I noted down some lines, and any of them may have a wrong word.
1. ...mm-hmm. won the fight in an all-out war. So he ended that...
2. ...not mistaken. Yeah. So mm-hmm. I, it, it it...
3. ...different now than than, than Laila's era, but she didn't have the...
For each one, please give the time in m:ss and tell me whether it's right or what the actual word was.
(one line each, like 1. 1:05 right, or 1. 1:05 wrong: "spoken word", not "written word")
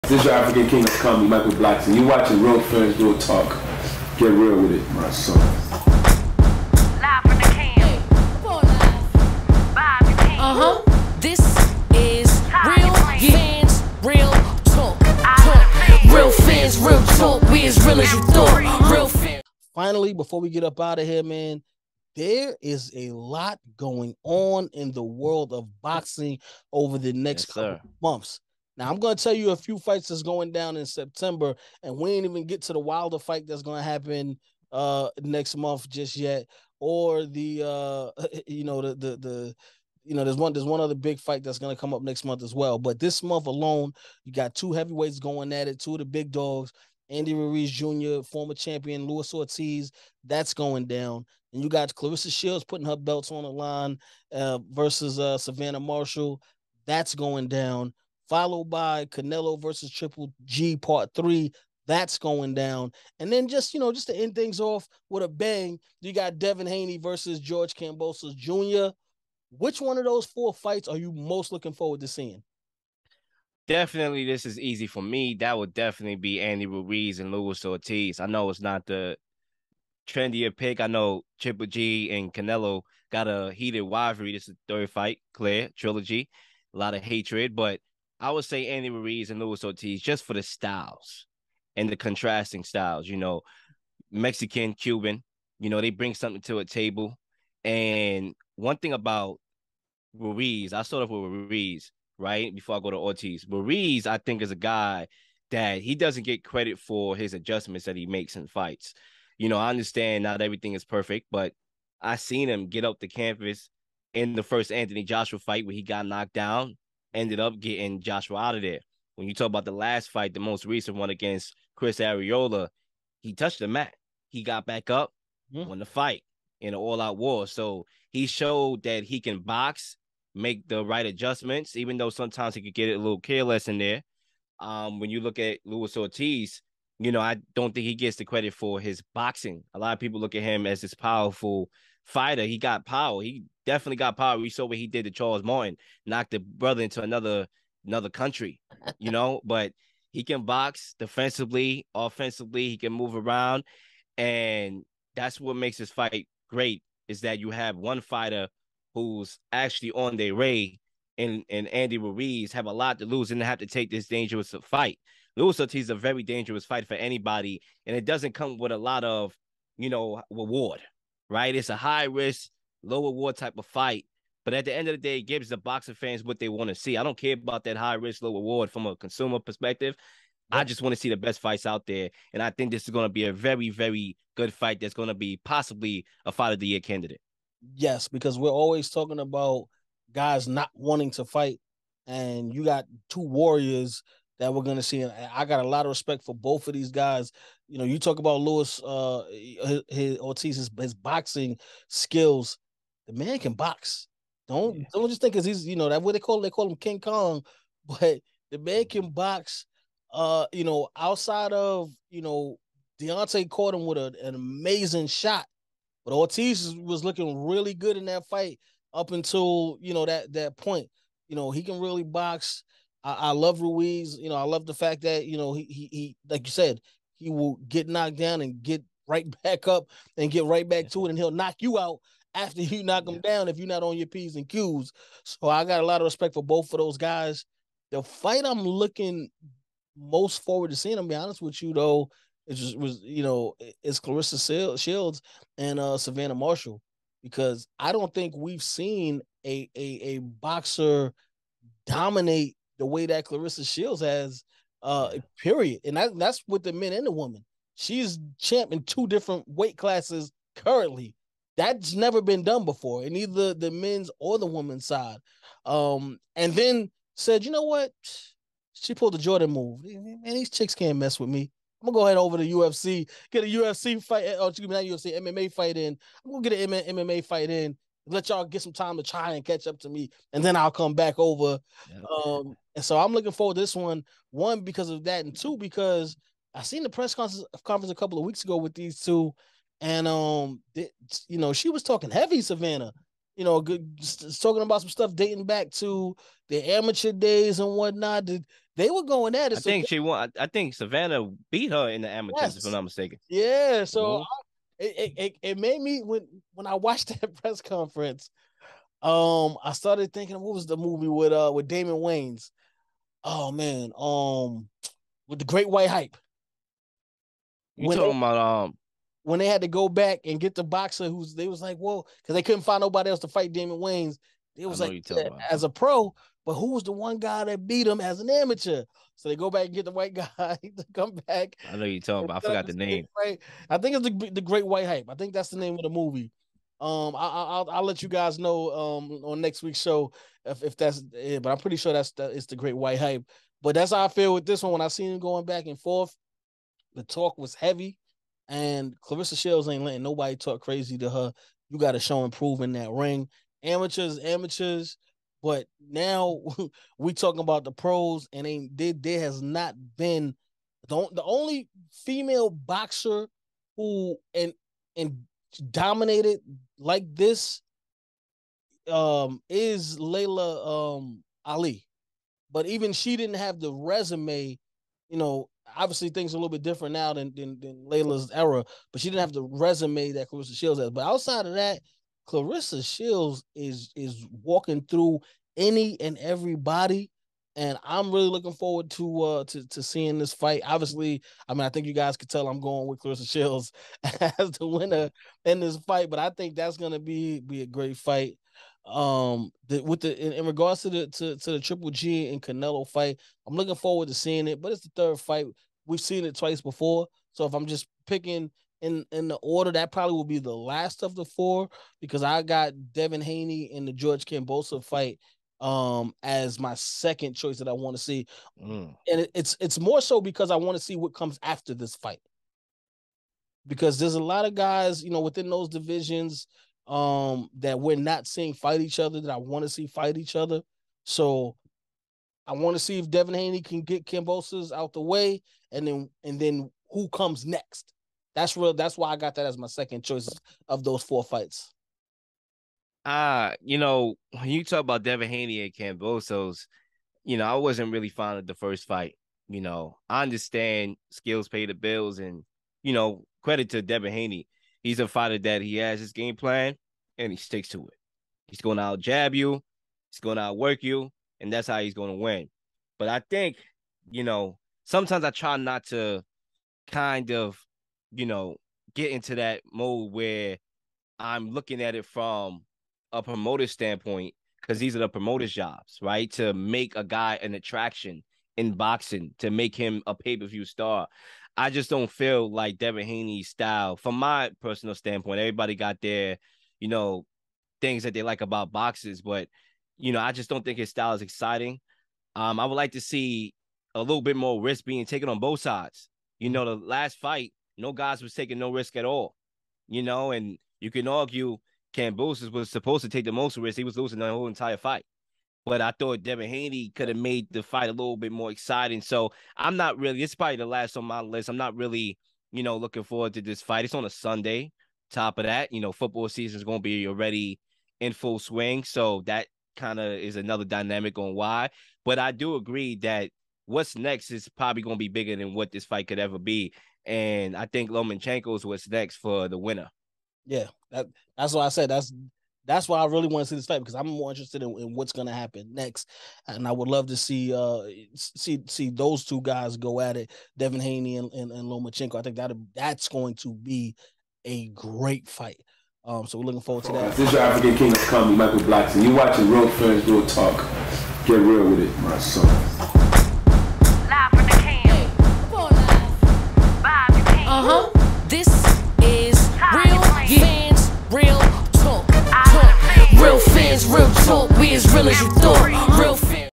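1. 2:05 wrong: "showed", not "ended"
2. 5:02 right
3. 6:16 right.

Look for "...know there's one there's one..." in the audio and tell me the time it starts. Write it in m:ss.
0:40.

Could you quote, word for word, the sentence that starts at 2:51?
It's a high risk, lower war type of fight.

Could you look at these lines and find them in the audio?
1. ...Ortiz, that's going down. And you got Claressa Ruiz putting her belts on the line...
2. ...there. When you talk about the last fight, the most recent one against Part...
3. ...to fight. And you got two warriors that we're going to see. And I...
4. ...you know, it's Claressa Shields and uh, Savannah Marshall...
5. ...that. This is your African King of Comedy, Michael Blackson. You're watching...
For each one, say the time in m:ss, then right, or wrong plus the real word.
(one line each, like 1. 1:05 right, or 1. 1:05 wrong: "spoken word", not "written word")
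1. 0:49 wrong: "Shields", not "Ruiz"
2. 1:58 wrong: "Chris", not "Part"
3. 3:11 right
4. 4:03 right
5. 9:06 right.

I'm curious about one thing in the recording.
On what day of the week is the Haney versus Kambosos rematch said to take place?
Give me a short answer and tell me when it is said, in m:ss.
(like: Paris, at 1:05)
Sunday, at 8:34.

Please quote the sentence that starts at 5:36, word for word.
Um, I, will I'll let you guys know um on next week's show if, if that's it.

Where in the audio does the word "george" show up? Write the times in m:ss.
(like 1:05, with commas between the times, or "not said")
1:07, 6:53.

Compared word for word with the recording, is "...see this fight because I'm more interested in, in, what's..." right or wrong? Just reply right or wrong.
right.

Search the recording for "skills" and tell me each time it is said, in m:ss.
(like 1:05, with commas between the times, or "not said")
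3:21, 7:31.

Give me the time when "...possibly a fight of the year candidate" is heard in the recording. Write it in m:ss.
3:05.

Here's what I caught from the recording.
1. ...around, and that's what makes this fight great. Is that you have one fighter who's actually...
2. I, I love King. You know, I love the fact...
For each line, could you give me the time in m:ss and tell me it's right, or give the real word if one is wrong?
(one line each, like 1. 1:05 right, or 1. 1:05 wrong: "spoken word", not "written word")
1. 2:33 right
2. 3:43 wrong: "Ruiz", not "King".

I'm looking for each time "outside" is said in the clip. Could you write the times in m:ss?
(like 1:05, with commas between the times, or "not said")
3:30, 6:21.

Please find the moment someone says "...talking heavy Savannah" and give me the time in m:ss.
4:51.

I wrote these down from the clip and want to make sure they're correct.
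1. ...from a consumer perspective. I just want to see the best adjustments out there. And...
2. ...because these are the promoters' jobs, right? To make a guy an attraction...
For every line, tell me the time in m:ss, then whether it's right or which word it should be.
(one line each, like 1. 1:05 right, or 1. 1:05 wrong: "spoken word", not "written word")
1. 2:58 wrong: "fights", not "adjustments"
2. 7:54 right.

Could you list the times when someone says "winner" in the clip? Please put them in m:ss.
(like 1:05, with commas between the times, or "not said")
6:34, 8:49.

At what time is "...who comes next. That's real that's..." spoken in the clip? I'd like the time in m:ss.
7:16.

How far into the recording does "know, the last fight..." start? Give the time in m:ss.
8:16.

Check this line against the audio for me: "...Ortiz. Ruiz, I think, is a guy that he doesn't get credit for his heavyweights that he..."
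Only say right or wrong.
wrong.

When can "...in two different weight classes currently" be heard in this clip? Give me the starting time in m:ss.
4:18.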